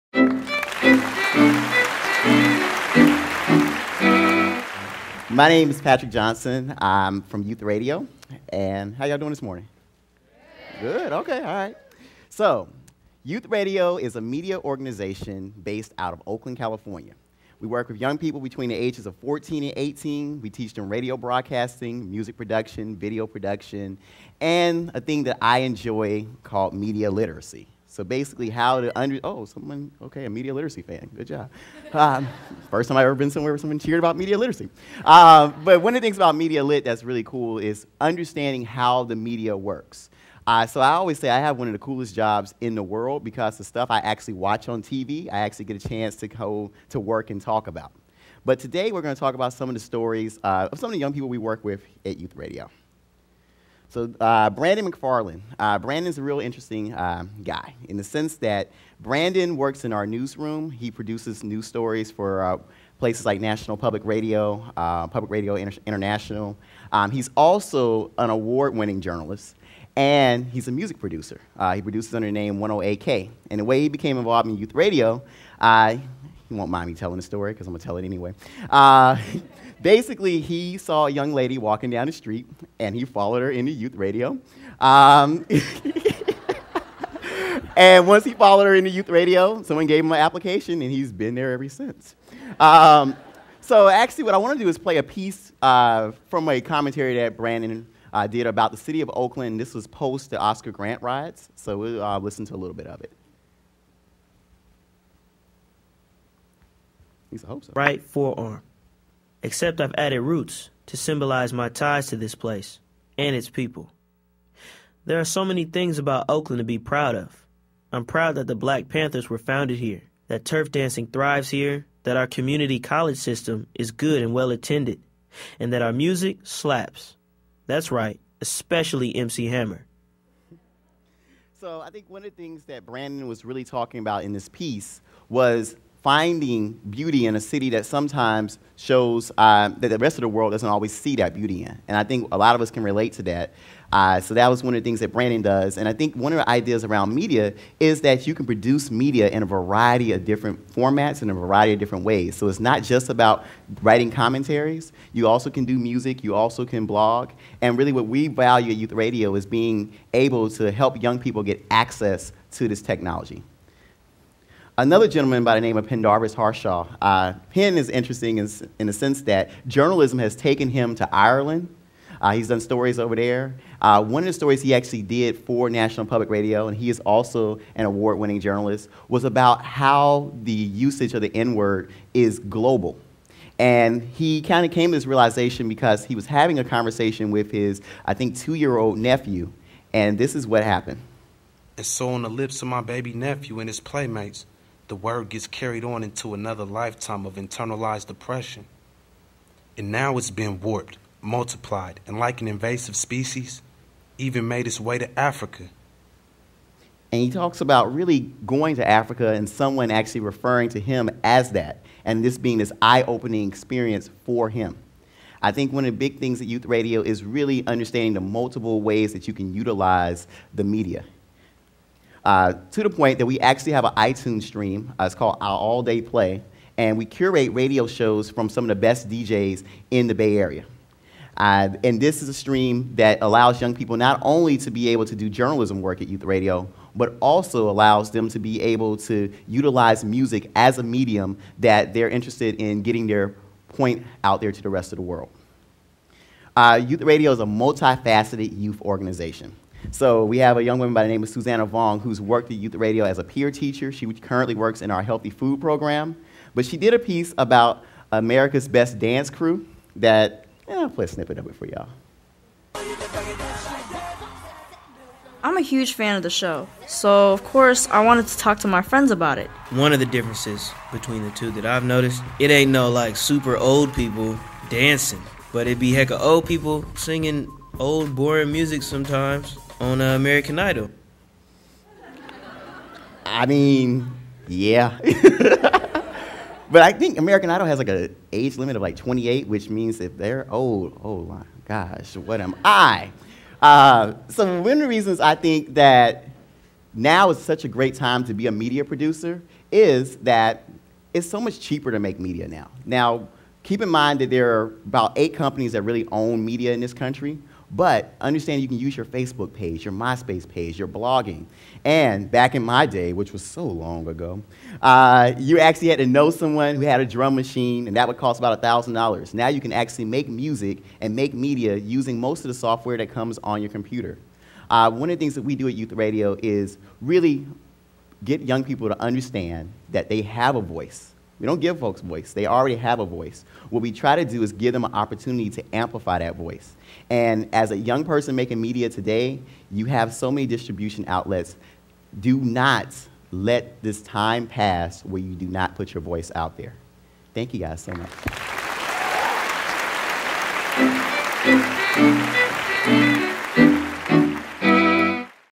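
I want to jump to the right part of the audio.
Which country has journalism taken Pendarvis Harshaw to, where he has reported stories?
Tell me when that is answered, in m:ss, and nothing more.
2:51.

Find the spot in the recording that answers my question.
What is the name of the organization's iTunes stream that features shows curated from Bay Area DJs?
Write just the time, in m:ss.
3:45.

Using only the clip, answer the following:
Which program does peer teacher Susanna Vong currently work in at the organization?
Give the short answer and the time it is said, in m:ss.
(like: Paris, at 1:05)
healthy food program, at 4:15.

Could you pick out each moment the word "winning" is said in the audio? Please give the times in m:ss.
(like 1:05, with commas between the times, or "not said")
1:08, 2:58.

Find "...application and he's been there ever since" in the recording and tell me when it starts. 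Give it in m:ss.
1:30.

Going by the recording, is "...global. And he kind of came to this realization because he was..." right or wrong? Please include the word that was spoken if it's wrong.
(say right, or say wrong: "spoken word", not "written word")
right.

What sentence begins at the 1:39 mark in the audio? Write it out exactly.
This was post the Oscar Grant riots, so we'll uh, listen to a little bit of it.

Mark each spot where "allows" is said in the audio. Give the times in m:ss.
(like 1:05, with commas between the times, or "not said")
3:53, 3:57.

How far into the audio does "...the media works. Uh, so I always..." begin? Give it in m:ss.
0:39.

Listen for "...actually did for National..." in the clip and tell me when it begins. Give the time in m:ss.
2:54.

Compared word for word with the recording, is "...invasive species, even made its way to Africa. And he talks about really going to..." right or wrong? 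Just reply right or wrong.
right.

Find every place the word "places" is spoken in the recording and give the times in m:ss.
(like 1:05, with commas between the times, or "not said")
1:02, 1:52.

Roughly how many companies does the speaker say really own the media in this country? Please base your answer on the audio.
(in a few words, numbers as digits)
8.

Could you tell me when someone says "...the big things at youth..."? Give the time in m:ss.
3:35.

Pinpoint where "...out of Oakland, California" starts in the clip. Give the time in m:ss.
0:15.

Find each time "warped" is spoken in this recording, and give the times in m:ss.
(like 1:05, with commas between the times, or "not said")
3:20.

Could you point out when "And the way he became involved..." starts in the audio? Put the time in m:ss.
1:13.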